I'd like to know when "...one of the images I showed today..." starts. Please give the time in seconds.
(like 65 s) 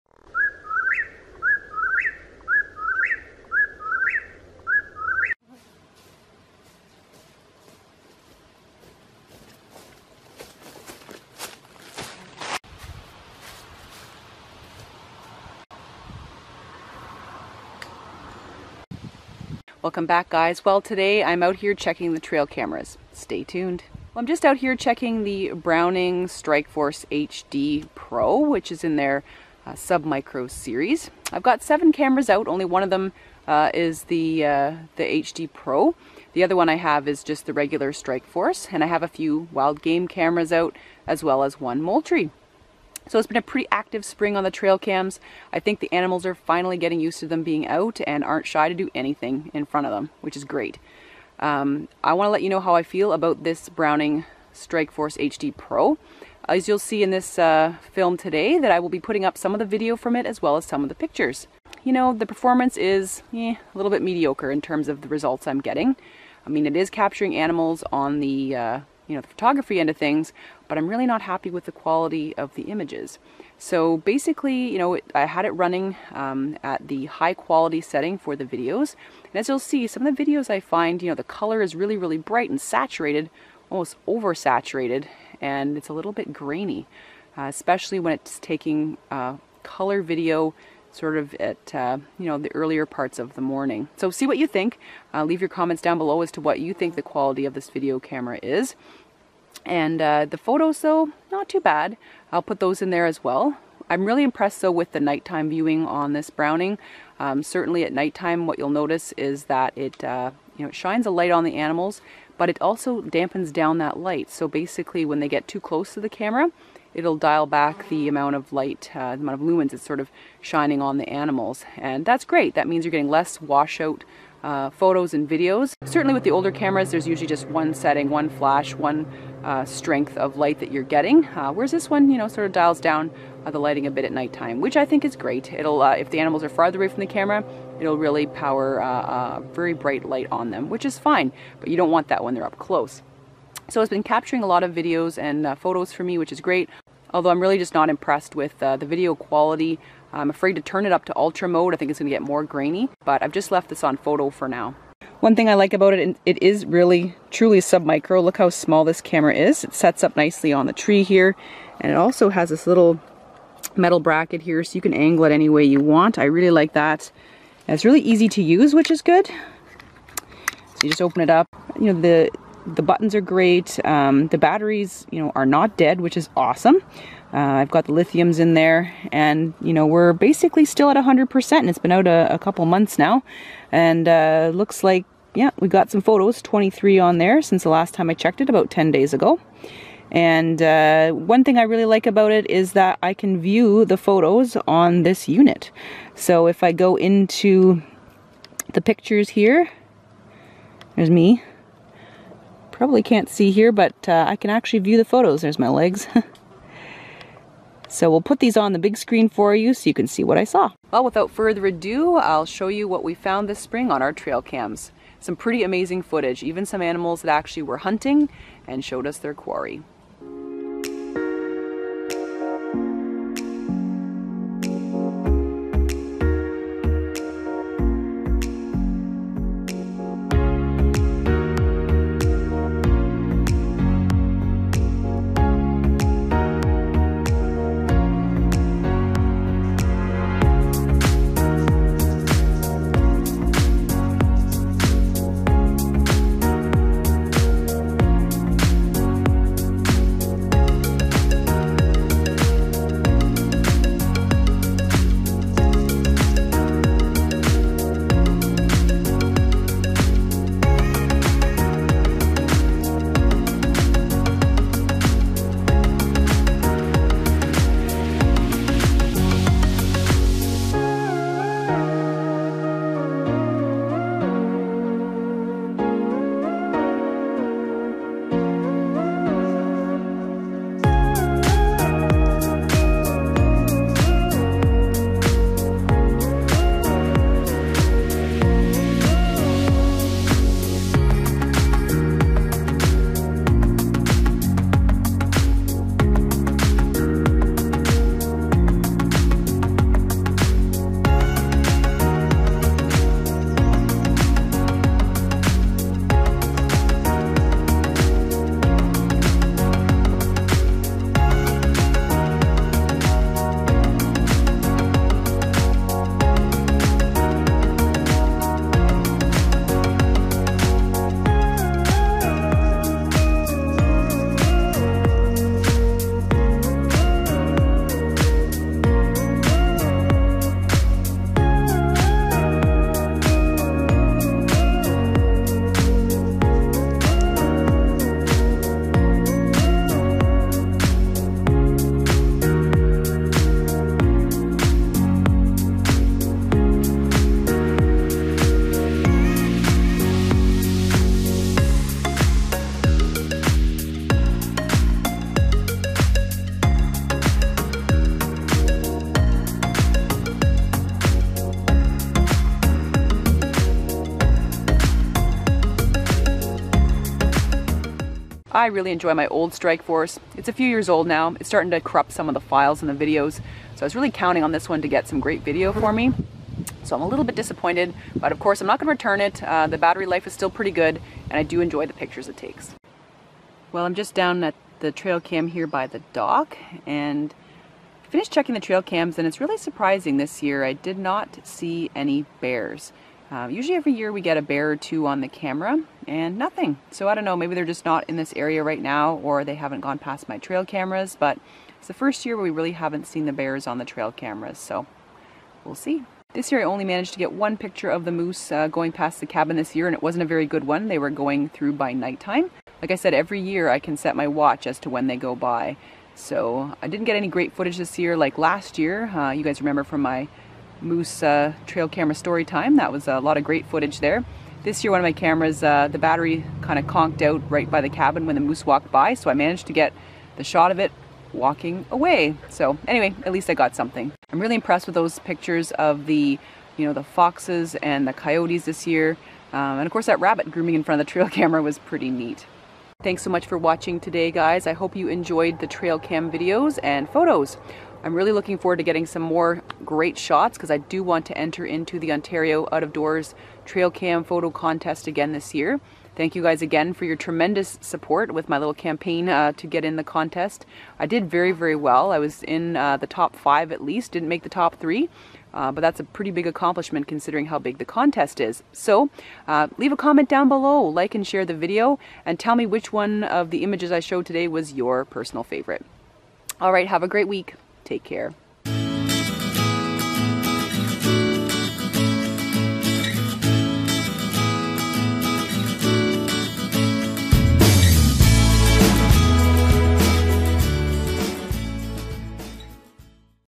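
472 s.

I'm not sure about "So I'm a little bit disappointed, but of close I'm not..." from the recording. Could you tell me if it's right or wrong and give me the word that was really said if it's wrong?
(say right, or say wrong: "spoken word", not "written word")
wrong: "course", not "close".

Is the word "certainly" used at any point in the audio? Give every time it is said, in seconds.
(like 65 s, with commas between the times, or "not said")
107 s, 125 s.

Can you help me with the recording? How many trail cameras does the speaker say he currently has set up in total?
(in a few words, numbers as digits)
7.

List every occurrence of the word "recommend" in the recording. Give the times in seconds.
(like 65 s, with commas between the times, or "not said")
not said.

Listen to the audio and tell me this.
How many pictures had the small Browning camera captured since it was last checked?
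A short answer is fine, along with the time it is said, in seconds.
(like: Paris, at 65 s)
23, at 186 s.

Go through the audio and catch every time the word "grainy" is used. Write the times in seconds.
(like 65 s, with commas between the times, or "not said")
86 s, 152 s.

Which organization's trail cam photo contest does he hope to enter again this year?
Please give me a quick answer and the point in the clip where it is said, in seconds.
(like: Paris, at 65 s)
Ontario Out of Doors, at 452 s.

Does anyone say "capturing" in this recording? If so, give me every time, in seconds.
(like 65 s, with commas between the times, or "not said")
66 s, 144 s.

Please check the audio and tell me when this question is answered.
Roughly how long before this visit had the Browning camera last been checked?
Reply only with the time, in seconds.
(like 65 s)
188 s.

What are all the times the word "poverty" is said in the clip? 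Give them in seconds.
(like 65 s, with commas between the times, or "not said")
not said.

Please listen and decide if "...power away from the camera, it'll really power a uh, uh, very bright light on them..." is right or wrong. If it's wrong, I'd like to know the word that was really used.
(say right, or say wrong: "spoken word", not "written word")
wrong: "farther", not "power".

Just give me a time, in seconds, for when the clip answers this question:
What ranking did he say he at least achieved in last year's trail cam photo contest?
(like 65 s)
463 s.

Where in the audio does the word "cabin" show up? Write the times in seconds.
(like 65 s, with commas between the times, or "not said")
409 s, 427 s.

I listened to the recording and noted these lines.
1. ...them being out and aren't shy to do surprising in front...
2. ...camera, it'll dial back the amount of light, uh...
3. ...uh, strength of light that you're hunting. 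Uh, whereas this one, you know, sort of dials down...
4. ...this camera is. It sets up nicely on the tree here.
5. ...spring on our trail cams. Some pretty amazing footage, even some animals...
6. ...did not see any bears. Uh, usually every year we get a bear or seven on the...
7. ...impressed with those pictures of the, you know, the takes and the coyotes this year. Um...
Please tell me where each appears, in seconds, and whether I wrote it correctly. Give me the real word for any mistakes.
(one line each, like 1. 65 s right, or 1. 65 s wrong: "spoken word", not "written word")
1. 47 s wrong: "anything", not "surprising"
2. 116 s right
3. 129 s wrong: "getting", not "hunting"
4. 158 s right
5. 213 s right
6. 390 s wrong: "two", not "seven"
7. 434 s wrong: "foxes", not "takes".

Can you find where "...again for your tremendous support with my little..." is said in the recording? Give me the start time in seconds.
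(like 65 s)
456 s.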